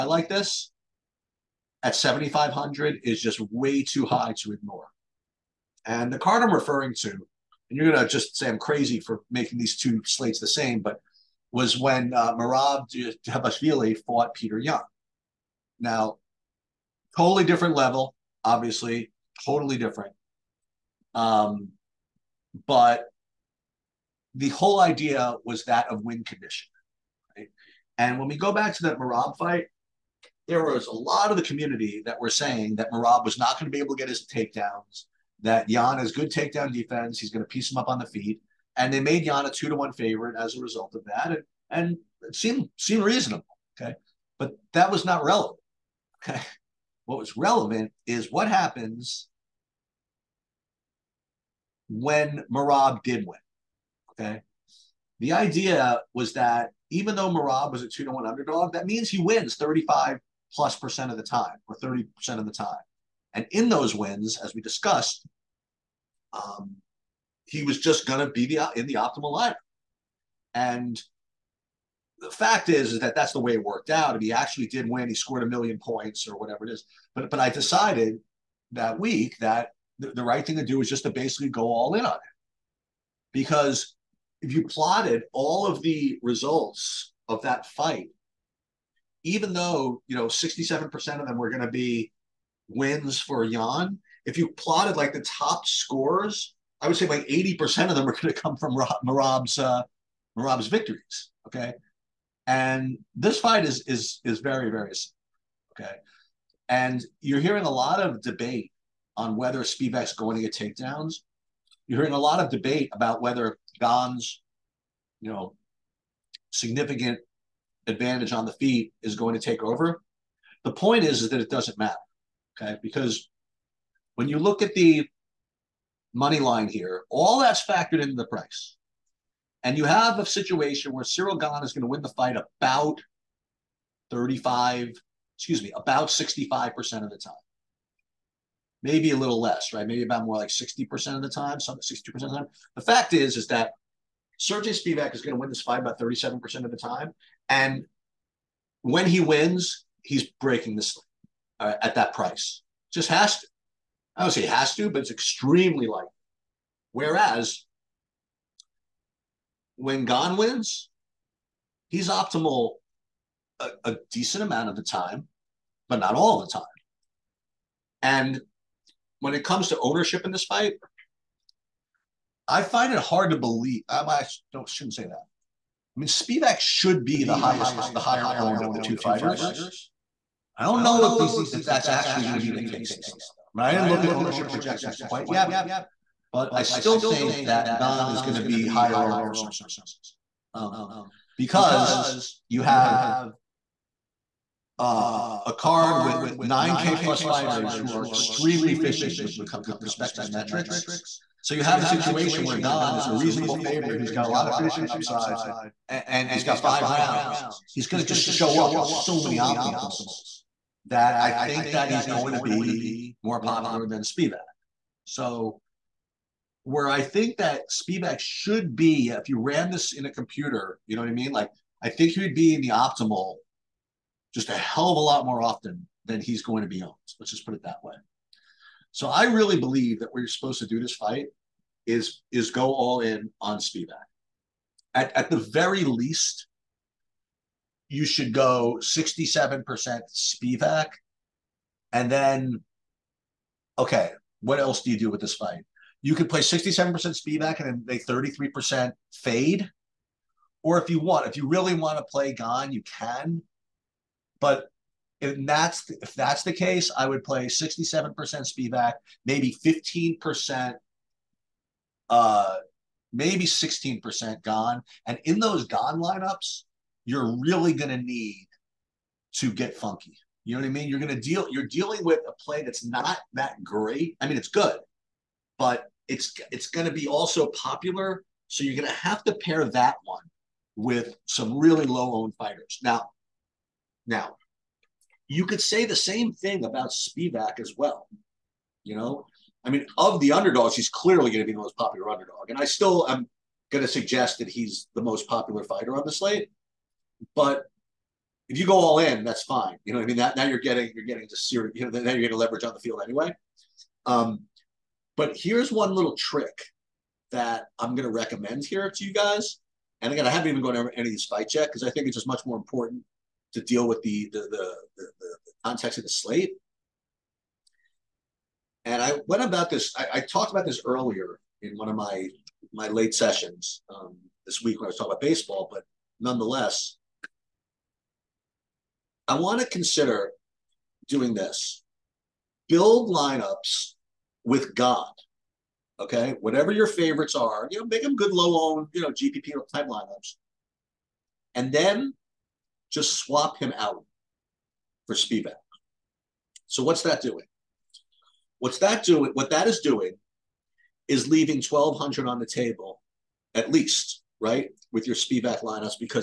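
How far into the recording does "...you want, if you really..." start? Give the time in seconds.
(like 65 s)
250 s.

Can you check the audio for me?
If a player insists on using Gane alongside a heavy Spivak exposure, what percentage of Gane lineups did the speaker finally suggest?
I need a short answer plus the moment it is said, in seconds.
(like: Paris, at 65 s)
16%, at 263 s.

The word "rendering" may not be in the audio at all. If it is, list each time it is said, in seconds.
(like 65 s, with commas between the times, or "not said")
not said.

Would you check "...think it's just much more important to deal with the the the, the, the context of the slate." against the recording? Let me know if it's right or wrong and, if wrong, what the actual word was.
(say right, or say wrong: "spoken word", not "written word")
right.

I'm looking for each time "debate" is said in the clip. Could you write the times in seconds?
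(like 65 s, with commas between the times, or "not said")
108 s, 112 s.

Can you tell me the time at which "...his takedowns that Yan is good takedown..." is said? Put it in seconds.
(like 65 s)
34 s.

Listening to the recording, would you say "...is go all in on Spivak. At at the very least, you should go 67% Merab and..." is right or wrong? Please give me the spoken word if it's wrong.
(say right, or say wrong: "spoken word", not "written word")
wrong: "Spivak", not "Merab".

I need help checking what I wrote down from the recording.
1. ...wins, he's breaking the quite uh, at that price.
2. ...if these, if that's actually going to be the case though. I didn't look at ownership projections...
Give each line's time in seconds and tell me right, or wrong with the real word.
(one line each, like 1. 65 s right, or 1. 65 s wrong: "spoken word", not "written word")
1. 149 s wrong: "slate", not "quite"
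2. 181 s right.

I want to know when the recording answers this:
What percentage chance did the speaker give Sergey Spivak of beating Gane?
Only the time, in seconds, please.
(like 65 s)
145 s.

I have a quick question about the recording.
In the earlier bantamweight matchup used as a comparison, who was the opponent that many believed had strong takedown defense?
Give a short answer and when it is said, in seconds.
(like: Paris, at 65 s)
Petr Yan, at 14 s.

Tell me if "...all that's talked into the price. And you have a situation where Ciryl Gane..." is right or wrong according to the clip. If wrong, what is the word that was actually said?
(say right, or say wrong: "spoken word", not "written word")
wrong: "factored", not "talked".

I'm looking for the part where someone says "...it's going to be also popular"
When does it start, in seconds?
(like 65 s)
276 s.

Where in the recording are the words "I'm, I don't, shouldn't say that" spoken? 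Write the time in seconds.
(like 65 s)
173 s.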